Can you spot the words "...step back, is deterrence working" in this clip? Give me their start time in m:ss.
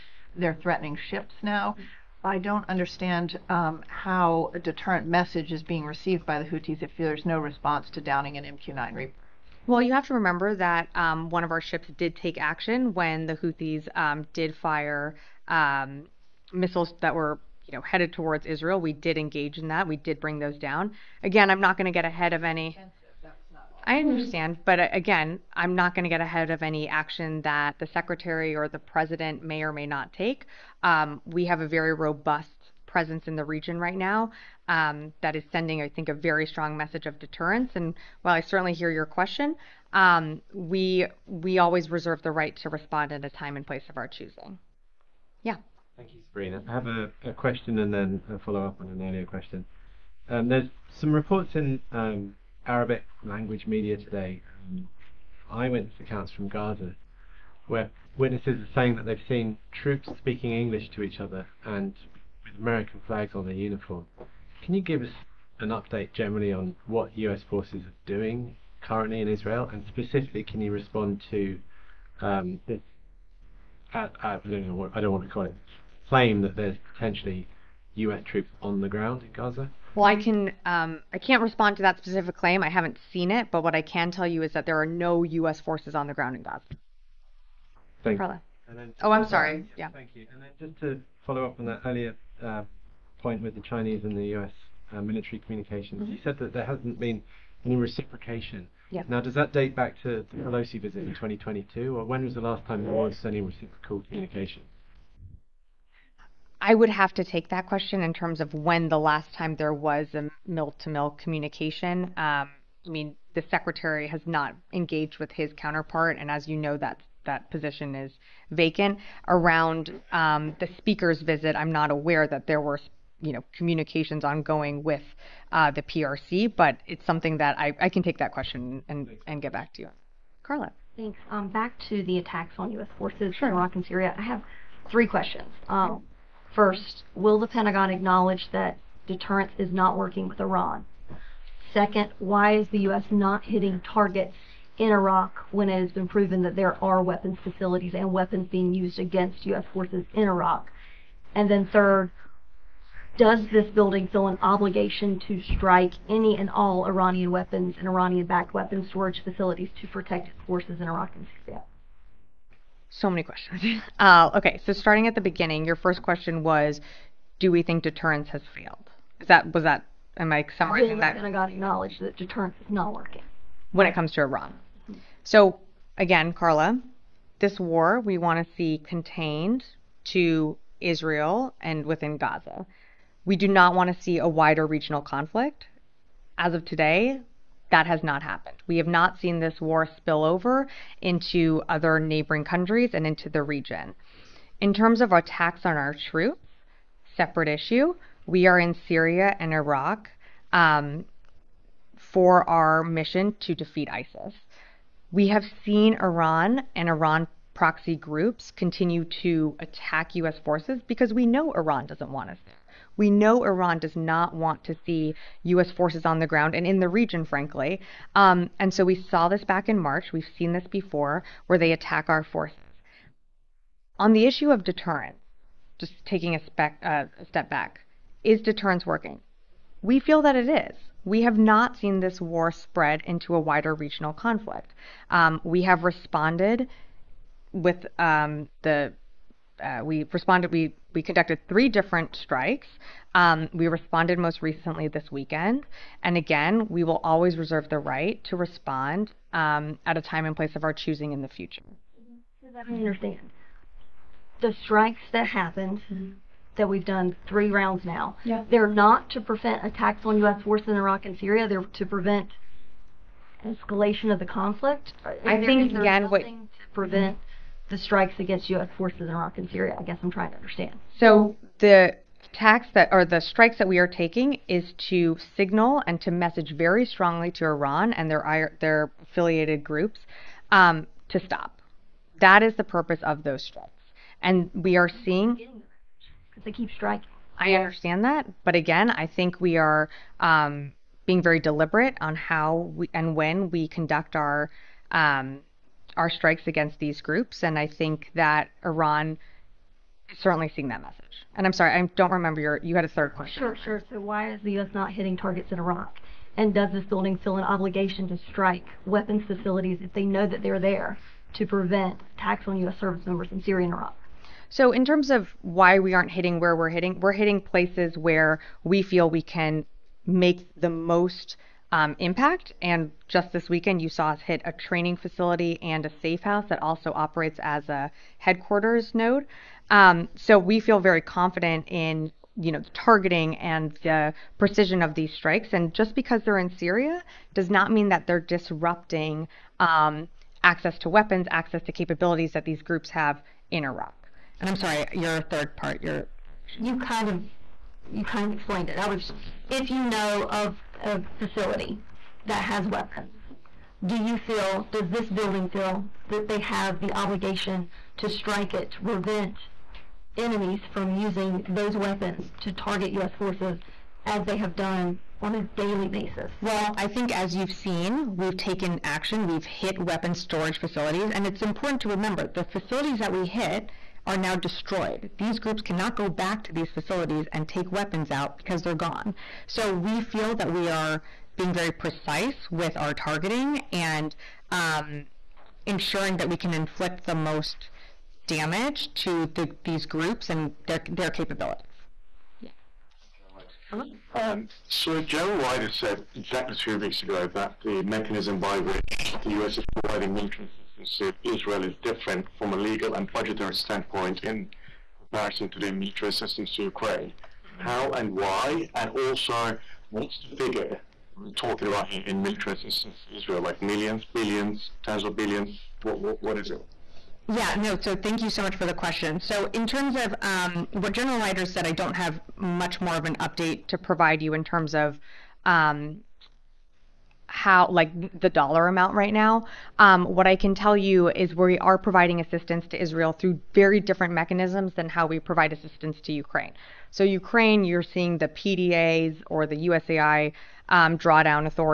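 3:47.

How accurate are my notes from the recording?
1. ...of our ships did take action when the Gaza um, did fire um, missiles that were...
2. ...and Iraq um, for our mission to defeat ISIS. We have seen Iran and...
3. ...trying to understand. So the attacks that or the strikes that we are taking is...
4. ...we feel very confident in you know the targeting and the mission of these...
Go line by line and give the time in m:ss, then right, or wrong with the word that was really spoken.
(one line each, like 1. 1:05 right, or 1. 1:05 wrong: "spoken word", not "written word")
1. 0:11 wrong: "Houthis", not "Gaza"
2. 3:19 right
3. 4:30 right
4. 5:30 wrong: "precision", not "mission".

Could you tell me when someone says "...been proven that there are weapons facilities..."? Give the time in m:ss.
2:25.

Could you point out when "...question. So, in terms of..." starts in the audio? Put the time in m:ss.
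6:58.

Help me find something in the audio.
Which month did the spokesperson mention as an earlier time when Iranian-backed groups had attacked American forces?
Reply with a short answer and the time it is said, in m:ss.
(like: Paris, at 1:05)
March, at 3:39.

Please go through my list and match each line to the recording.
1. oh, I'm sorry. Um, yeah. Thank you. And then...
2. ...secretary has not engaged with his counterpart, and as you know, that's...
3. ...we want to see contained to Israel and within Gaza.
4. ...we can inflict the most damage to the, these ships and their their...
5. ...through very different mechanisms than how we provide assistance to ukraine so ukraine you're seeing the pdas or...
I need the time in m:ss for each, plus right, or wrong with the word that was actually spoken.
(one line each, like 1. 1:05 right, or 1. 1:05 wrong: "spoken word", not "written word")
1. 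1:29 right
2. 1:53 right
3. 2:57 right
4. 6:26 wrong: "groups", not "ships"
5. 7:13 right.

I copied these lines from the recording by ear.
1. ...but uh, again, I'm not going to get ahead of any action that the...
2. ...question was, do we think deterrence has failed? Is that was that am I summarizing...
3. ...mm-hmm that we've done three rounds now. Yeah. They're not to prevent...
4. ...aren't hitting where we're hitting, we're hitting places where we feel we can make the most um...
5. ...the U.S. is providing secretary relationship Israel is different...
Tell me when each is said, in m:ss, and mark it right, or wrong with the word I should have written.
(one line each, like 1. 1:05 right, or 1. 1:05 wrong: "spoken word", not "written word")
1. 0:24 right
2. 2:46 right
3. 4:15 right
4. 5:15 right
5. 6:39 wrong: "military", not "secretary".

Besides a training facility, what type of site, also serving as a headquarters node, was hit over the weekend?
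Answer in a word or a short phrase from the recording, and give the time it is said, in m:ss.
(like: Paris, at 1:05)
Safe house, at 5:26.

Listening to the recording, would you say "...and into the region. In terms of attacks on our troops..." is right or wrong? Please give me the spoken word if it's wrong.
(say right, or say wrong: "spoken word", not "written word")
right.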